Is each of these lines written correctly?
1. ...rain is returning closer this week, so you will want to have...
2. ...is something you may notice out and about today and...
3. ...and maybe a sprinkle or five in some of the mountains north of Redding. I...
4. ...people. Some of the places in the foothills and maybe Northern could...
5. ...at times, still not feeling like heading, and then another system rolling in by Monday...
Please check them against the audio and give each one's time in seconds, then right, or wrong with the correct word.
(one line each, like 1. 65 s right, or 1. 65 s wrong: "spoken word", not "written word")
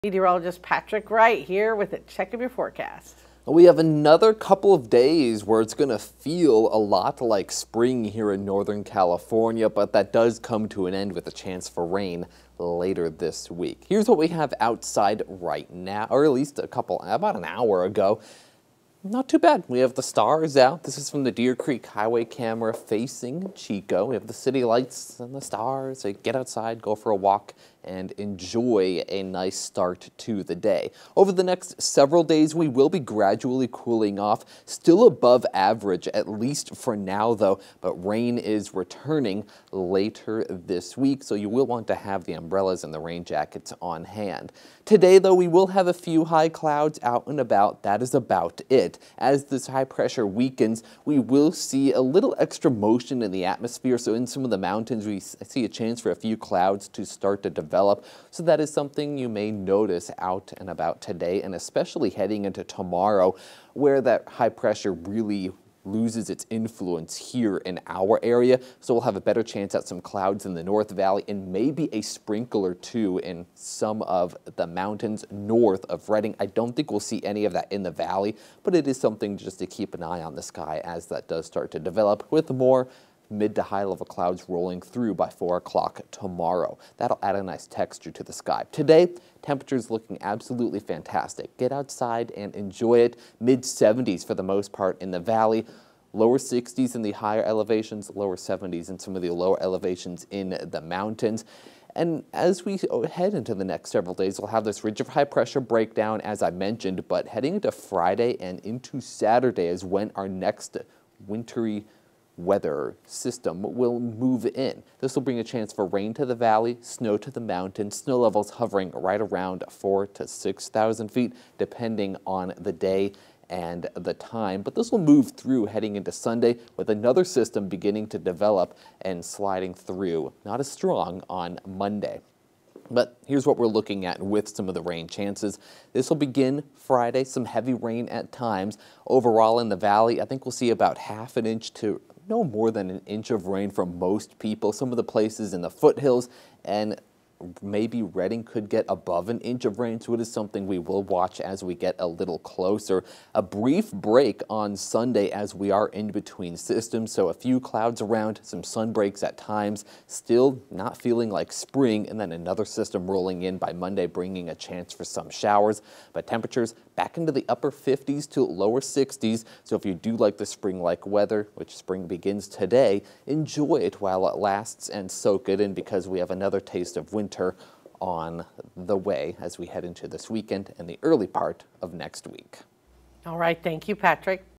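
1. 37 s wrong: "later", not "closer"
2. 58 s right
3. 71 s wrong: "two", not "five"
4. 144 s wrong: "Redding", not "Northern"
5. 159 s wrong: "spring", not "heading".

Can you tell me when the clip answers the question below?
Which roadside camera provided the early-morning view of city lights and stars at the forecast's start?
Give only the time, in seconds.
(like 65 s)
21 s.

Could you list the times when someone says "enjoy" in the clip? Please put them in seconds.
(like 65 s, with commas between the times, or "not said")
28 s, 92 s, 173 s.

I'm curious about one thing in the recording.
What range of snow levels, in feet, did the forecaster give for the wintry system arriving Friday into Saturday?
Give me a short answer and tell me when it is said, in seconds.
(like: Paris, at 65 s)
4 to 6,000 feet, at 119 s.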